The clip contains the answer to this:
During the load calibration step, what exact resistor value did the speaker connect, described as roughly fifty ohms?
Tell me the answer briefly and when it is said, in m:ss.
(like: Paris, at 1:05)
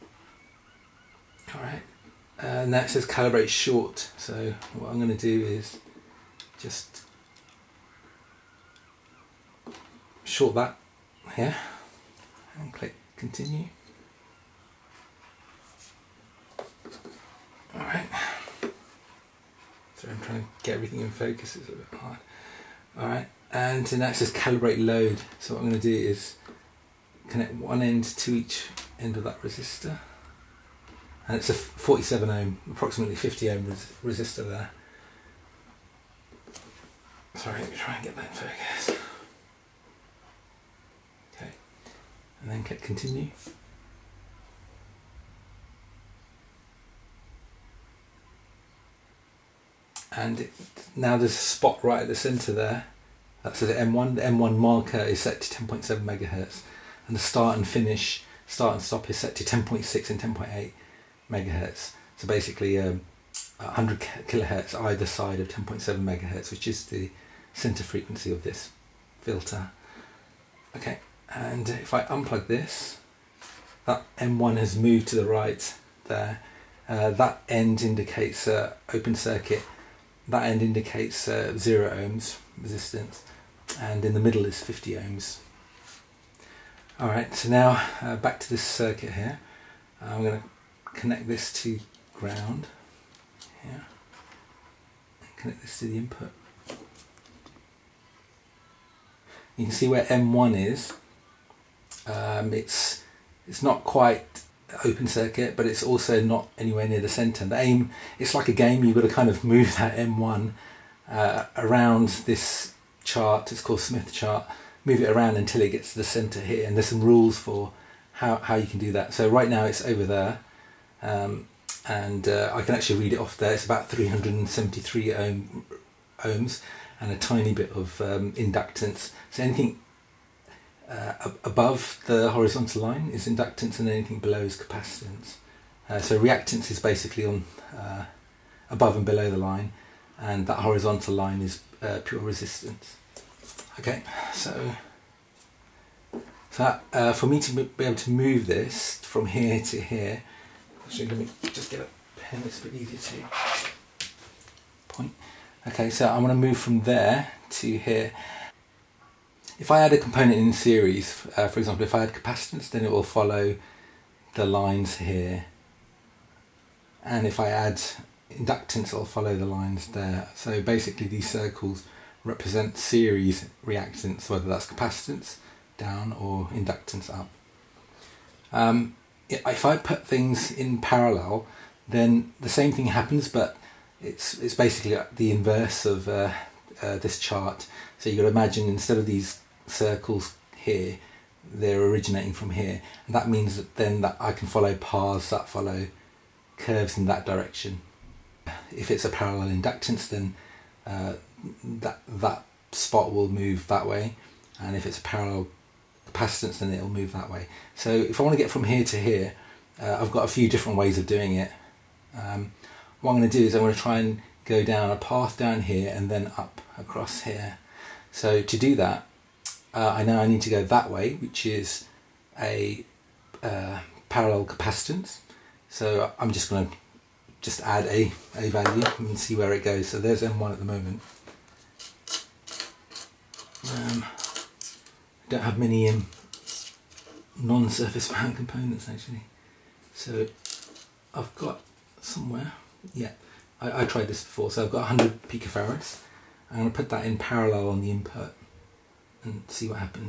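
47 ohm, at 0:31.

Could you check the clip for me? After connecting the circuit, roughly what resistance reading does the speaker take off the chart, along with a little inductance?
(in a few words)
373 ohms.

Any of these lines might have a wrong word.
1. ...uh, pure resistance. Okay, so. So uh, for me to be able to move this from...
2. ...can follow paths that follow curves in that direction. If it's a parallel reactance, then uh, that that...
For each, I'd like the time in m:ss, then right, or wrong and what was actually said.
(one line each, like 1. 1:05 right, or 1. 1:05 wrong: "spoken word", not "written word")
1. 2:21 right
2. 3:14 wrong: "inductance", not "reactance".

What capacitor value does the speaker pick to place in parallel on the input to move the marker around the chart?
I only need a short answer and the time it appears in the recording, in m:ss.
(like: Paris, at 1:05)
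100 picofarads, at 4:04.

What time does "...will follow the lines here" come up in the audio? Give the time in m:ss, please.
2:42.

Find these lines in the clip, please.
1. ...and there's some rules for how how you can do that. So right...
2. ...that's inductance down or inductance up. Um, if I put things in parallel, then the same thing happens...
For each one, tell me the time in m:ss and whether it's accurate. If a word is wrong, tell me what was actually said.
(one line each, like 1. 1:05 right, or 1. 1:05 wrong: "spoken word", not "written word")
1. 1:56 right
2. 2:54 wrong: "capacitance", not "inductance".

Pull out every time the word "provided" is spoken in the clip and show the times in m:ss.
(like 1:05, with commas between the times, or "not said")
not said.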